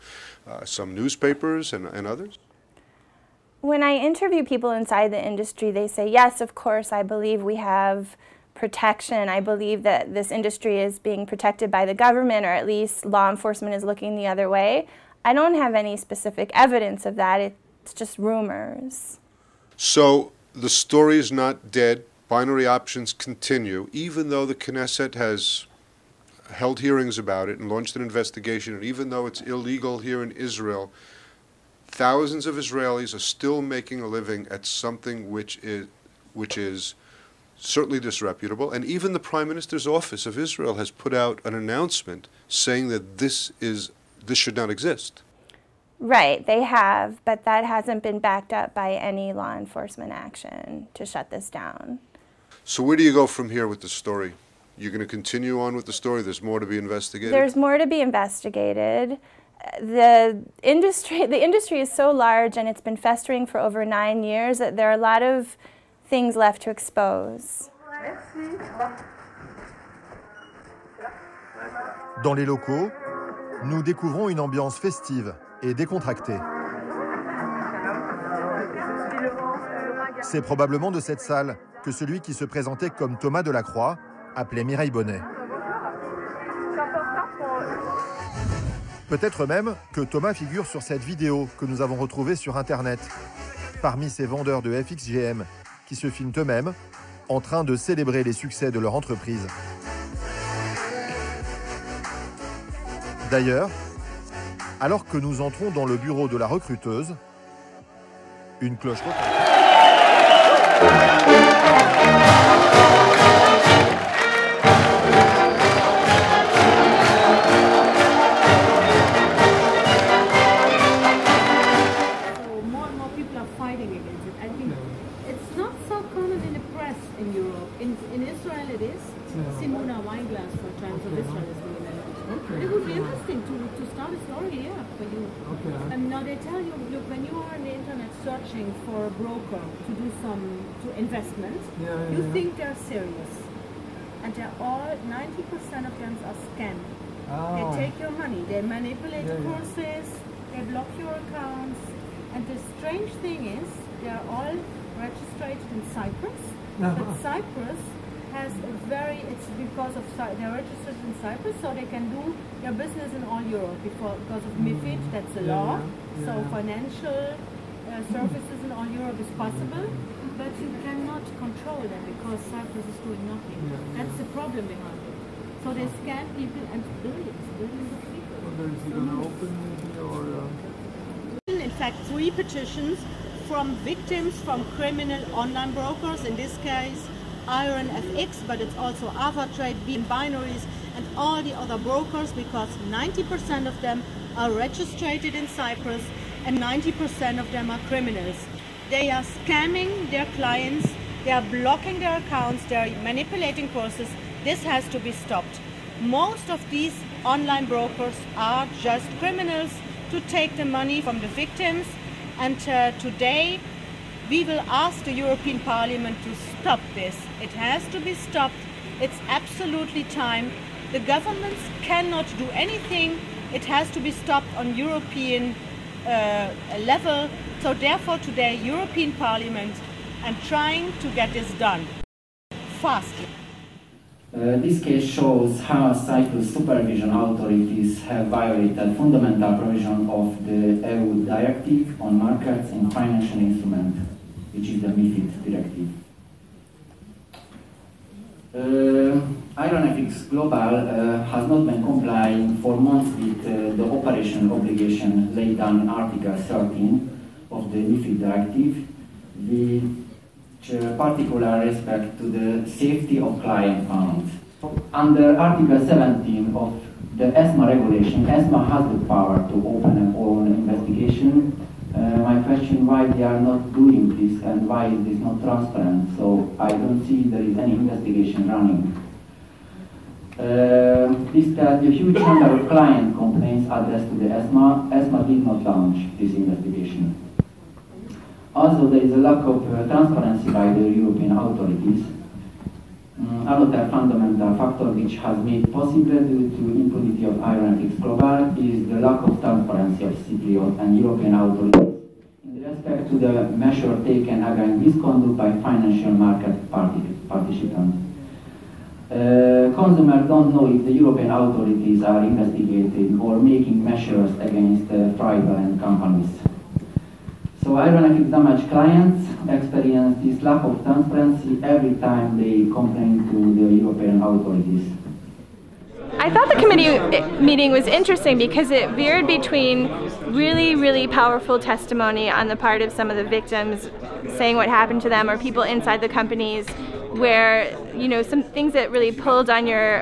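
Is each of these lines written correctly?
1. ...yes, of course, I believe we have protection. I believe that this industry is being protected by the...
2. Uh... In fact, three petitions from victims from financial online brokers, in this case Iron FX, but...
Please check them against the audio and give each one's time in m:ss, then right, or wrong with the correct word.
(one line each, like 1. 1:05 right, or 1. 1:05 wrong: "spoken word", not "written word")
1. 0:06 right
2. 3:00 wrong: "criminal", not "financial".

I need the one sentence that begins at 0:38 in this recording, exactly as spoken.
And even the Prime Minister's office of Israel has put out an announcement saying that this is this should not exist.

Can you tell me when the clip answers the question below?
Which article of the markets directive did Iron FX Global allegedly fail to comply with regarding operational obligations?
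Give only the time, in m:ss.
4:15.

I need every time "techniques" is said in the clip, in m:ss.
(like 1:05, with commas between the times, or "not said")
not said.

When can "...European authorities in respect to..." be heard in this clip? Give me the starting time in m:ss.
5:01.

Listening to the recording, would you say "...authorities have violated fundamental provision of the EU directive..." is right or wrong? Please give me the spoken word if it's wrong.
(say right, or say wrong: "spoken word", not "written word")
right.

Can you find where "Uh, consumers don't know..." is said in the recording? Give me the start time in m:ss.
5:09.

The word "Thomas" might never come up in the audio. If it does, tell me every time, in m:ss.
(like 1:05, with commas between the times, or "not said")
1:23, 1:30.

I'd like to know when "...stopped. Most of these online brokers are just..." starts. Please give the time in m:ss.
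3:25.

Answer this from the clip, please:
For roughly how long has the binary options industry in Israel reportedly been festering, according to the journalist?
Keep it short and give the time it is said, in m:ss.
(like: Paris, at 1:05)
9 years, at 1:03.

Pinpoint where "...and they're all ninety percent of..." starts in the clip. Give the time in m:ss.
2:24.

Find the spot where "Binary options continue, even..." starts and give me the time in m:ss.
0:22.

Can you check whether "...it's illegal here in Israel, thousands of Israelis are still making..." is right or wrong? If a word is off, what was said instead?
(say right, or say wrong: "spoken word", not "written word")
right.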